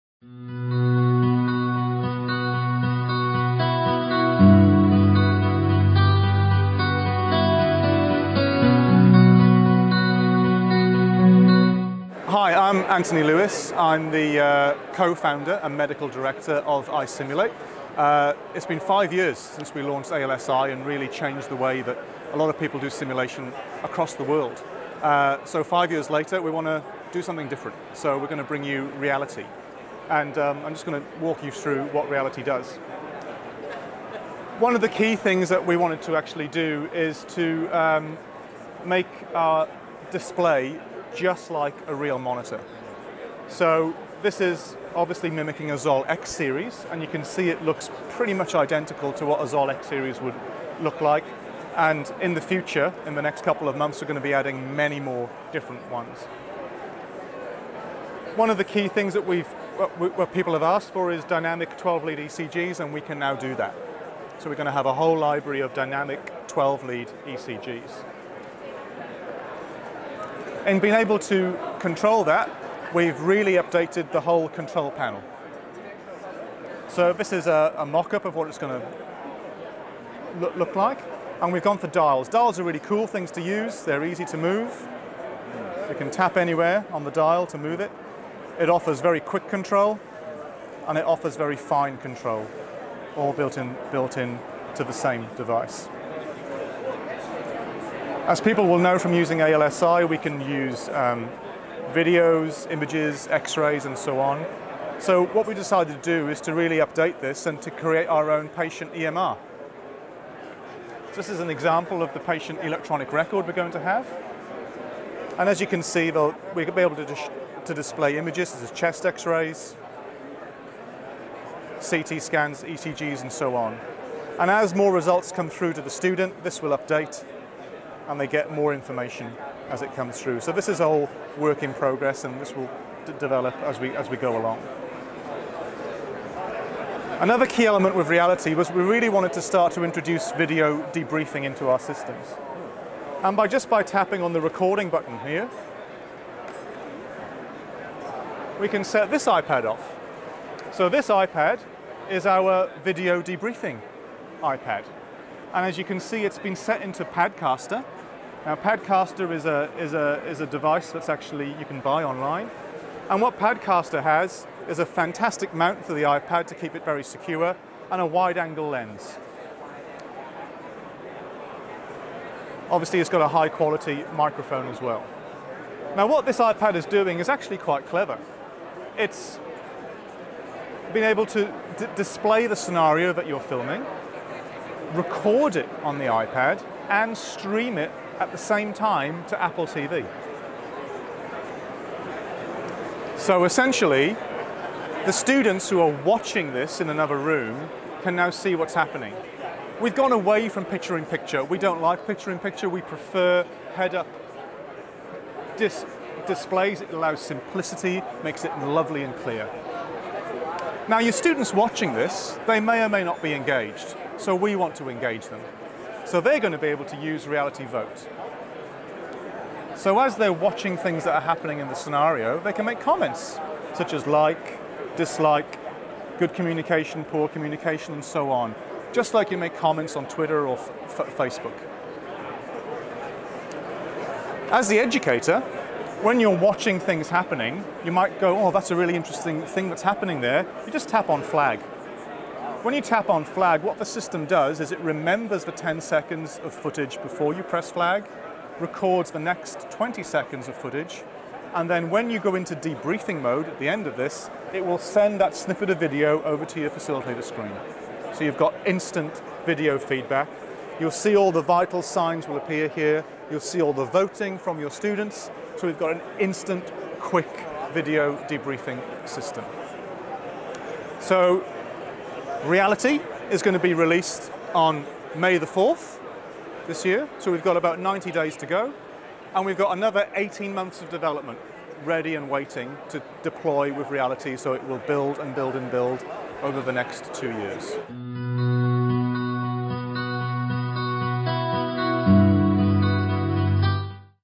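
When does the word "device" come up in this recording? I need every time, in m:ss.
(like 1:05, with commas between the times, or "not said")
1:35, 2:40.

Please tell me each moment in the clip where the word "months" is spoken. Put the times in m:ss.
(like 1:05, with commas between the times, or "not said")
0:53, 4:40.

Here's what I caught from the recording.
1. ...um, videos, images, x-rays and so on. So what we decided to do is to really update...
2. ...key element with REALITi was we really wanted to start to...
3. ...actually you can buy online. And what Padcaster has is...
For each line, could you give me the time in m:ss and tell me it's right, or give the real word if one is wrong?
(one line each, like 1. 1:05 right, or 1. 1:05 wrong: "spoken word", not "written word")
1. 1:40 right
2. 2:17 right
3. 2:41 right.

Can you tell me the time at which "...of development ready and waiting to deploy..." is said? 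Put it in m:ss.
4:40.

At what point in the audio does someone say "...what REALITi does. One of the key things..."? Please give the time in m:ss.
0:31.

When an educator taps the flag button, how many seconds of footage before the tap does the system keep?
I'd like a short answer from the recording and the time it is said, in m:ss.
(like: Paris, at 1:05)
10 seconds, at 4:05.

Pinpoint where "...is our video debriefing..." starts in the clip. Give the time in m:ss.
2:32.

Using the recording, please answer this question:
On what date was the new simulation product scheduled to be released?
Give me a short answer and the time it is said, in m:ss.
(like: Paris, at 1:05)
May 4, at 4:35.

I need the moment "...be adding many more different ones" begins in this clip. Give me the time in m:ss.
0:54.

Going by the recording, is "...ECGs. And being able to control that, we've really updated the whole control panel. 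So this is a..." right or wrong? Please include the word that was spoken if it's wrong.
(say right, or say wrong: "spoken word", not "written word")
right.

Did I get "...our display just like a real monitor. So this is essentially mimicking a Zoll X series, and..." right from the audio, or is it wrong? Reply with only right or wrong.
wrong.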